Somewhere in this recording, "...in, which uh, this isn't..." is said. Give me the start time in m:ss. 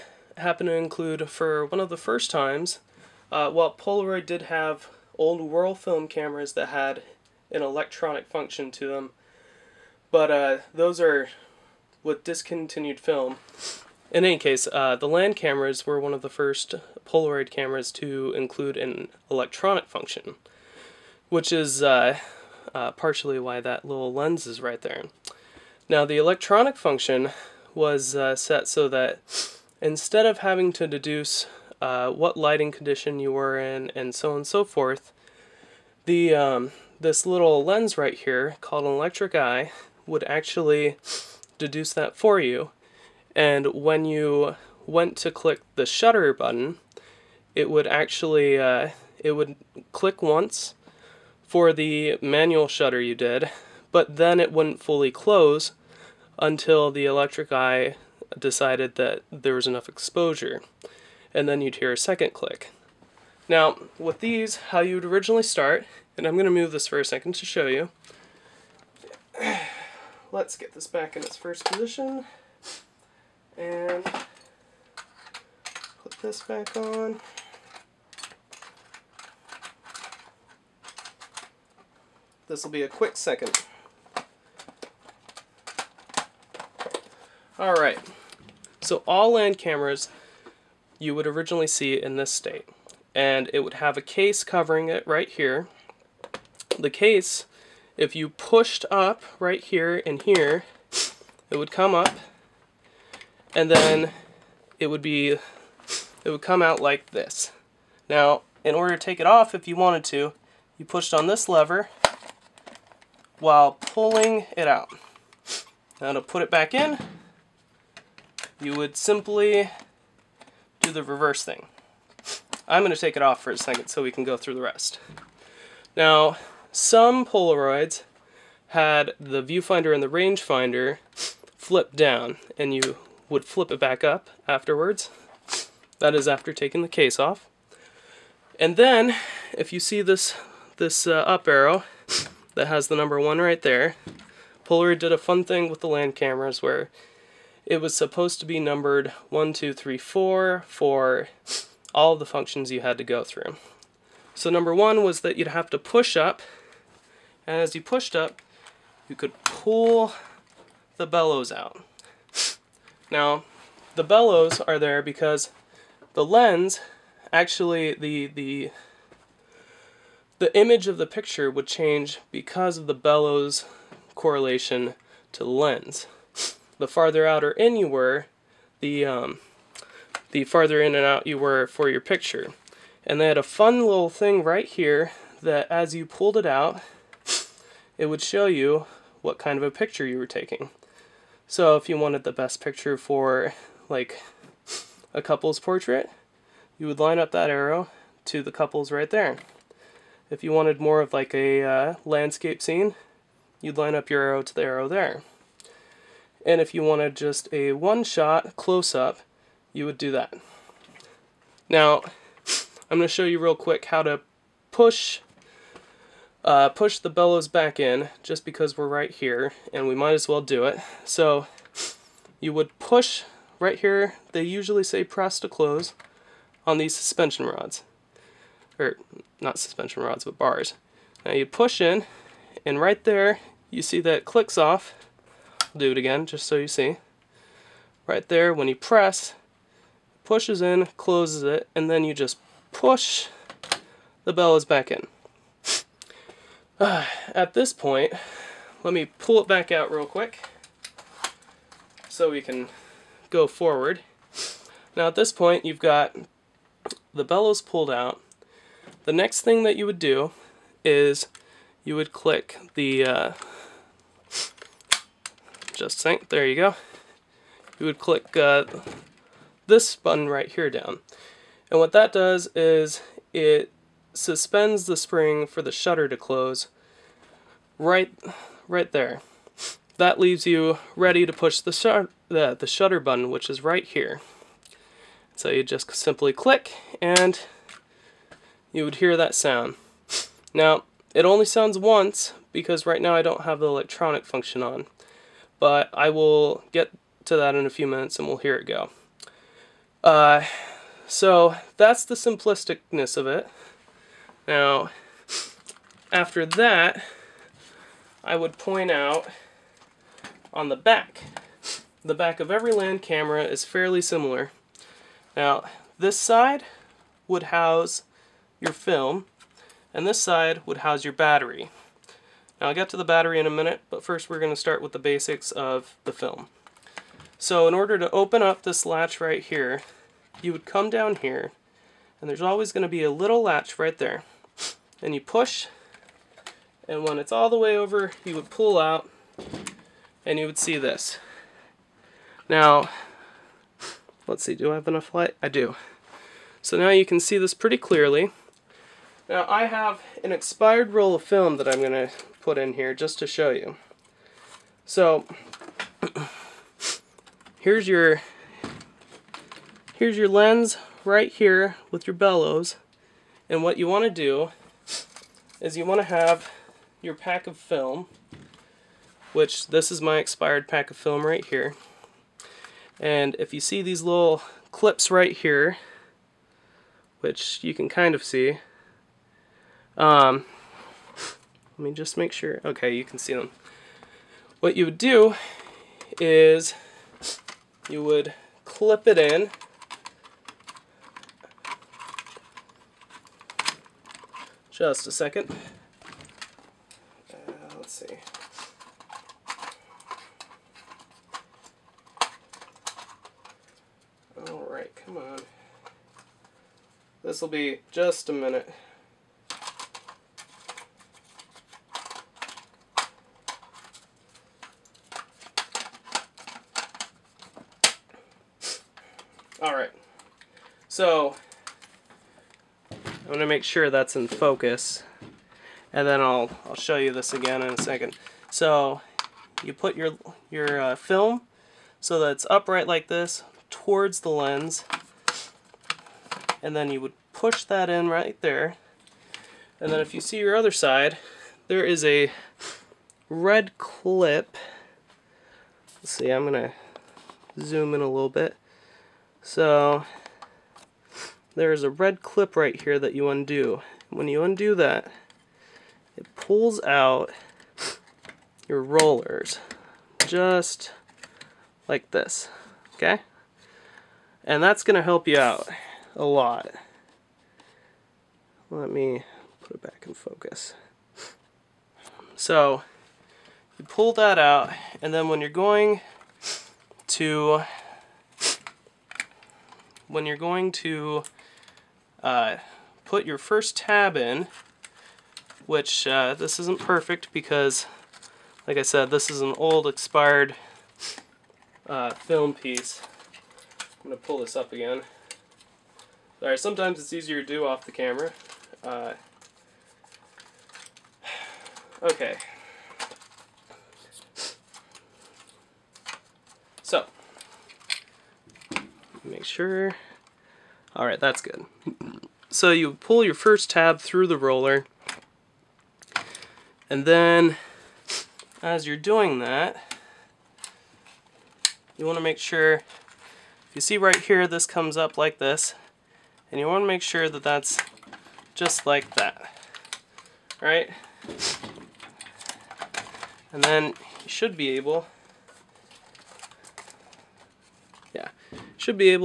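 8:04.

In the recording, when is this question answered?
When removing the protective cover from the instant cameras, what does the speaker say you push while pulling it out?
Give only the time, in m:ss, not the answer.
1:51.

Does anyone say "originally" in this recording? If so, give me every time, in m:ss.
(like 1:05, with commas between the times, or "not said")
1:05, 1:31.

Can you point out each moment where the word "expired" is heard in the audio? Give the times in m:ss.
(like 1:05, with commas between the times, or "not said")
5:50, 6:10, 8:09.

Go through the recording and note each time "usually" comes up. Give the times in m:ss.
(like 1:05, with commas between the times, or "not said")
3:44.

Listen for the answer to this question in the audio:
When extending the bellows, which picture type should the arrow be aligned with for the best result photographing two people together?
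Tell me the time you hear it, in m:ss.
3:18.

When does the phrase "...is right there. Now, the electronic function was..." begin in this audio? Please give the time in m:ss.
0:24.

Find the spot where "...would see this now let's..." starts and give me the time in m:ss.
5:40.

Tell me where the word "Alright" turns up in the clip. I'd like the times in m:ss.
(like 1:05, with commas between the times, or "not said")
1:27, 6:44, 6:59.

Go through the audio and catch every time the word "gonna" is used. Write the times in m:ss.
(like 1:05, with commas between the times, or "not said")
5:51, 7:03, 7:26, 7:44.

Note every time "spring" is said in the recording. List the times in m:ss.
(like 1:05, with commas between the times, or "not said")
4:34.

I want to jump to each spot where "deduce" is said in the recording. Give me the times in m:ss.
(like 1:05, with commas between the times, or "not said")
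0:30, 0:41.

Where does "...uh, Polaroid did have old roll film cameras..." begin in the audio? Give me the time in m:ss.
0:03.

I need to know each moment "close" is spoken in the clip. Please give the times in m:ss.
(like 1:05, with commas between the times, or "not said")
0:55, 3:28, 3:45, 4:00, 4:36.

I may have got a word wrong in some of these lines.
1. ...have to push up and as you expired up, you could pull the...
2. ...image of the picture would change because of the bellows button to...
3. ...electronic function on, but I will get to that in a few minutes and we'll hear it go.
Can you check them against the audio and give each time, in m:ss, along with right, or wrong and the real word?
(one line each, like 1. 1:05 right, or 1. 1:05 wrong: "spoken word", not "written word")
1. 2:35 wrong: "pushed", not "expired"
2. 2:50 wrong: "correlation", not "button"
3. 4:53 right.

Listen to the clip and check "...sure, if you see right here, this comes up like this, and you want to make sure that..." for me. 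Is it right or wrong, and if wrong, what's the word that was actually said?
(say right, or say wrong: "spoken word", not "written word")
right.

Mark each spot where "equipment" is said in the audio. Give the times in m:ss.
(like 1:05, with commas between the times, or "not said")
not said.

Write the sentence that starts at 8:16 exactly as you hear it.
Sorry, sometimes it's easier to do off the camera.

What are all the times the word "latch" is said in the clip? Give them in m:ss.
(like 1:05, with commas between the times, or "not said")
5:28, 5:33.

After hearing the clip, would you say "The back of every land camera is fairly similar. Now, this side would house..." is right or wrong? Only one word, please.
right.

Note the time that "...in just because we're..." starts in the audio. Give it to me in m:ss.
3:37.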